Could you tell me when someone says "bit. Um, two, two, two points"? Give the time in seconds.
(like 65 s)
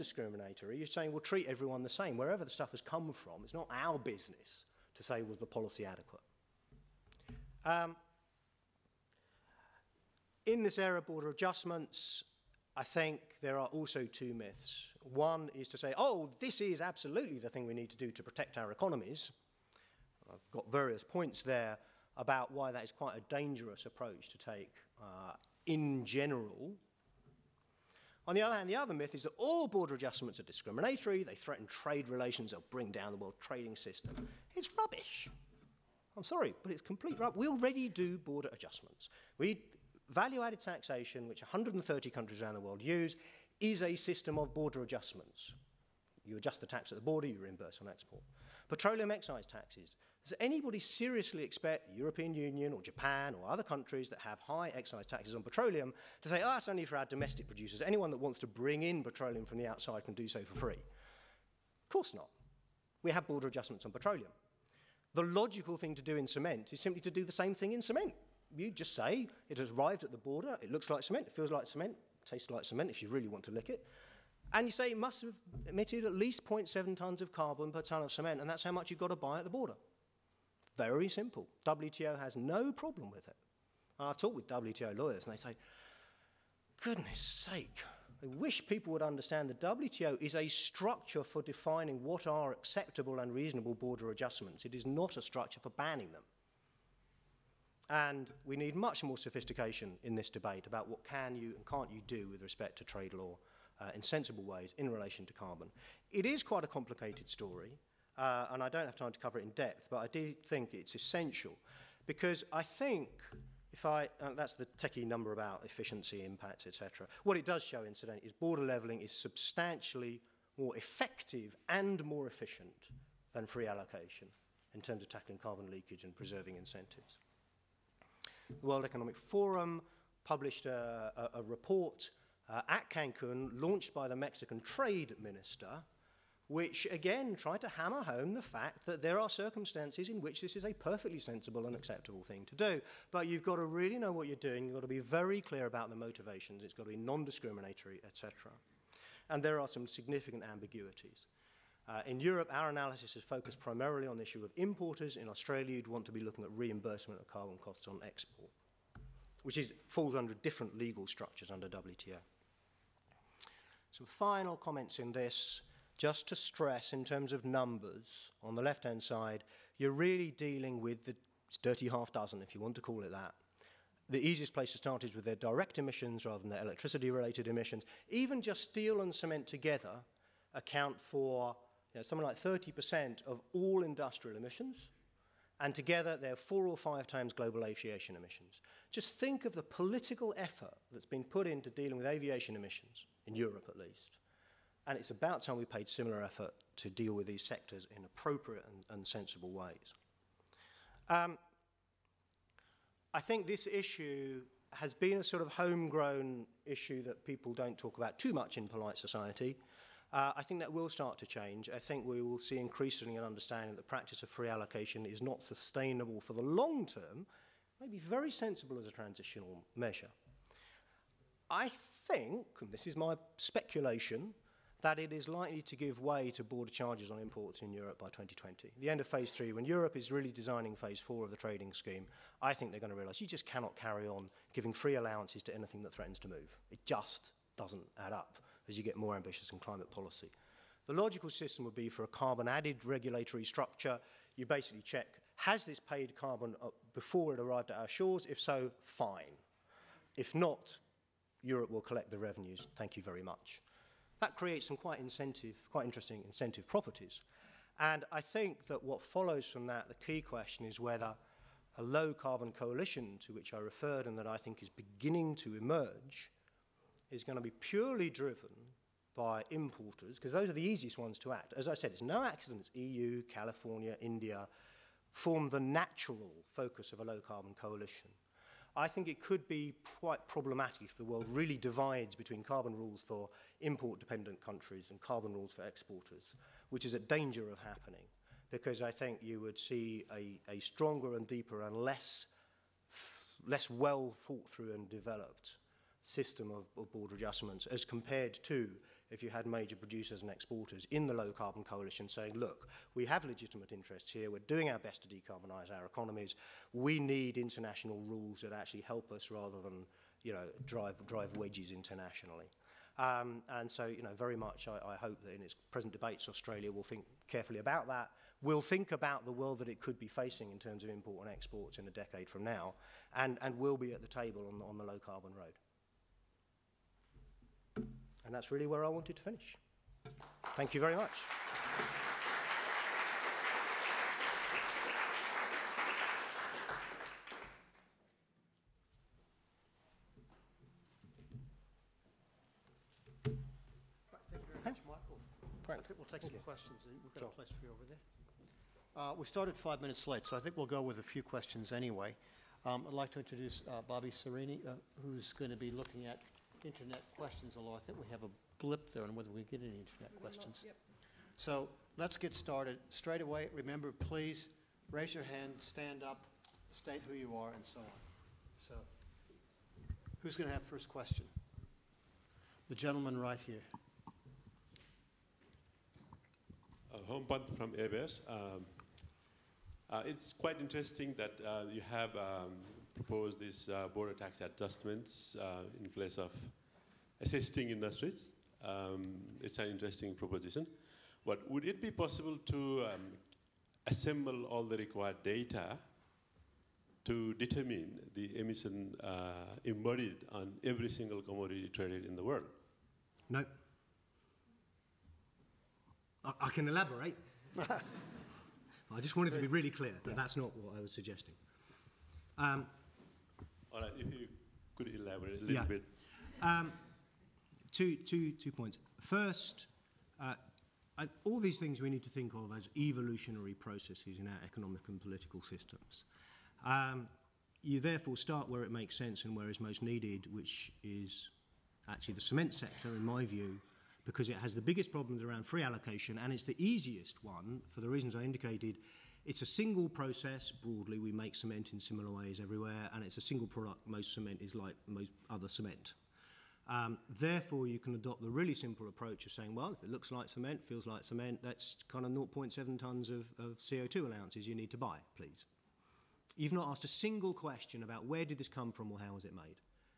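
415 s.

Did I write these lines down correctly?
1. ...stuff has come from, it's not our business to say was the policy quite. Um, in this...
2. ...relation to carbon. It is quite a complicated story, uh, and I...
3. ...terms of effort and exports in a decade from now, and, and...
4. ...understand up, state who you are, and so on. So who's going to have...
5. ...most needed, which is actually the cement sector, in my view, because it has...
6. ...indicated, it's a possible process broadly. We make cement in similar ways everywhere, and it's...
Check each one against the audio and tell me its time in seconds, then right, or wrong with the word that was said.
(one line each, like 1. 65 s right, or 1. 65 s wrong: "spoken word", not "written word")
1. 2 s wrong: "adequate", not "quite"
2. 104 s right
3. 320 s wrong: "import", not "effort"
4. 365 s wrong: "stand", not "understand"
5. 429 s right
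6. 438 s wrong: "single", not "possible".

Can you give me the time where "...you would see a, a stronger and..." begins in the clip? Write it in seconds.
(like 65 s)
289 s.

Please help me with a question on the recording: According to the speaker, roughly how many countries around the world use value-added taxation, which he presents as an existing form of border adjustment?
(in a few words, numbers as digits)
130.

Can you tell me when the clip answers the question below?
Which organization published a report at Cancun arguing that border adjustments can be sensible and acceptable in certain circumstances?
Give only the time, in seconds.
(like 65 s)
128 s.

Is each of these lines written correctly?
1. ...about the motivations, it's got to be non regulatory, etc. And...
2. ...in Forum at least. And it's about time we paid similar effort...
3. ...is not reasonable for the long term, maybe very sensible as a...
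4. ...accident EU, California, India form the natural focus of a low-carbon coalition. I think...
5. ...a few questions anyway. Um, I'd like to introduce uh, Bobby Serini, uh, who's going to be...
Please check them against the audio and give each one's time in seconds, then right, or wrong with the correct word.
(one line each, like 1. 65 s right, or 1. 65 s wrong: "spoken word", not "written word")
1. 145 s wrong: "discriminatory", not "regulatory"
2. 193 s wrong: "Europe", not "Forum"
3. 215 s wrong: "sustainable", not "reasonable"
4. 272 s right
5. 350 s right.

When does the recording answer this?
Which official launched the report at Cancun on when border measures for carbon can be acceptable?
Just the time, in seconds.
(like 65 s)
134 s.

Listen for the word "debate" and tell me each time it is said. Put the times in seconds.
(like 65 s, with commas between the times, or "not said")
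100 s, 315 s.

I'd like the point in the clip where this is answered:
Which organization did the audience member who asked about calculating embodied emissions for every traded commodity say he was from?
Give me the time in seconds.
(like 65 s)
377 s.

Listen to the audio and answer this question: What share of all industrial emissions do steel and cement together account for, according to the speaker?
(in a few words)
30%.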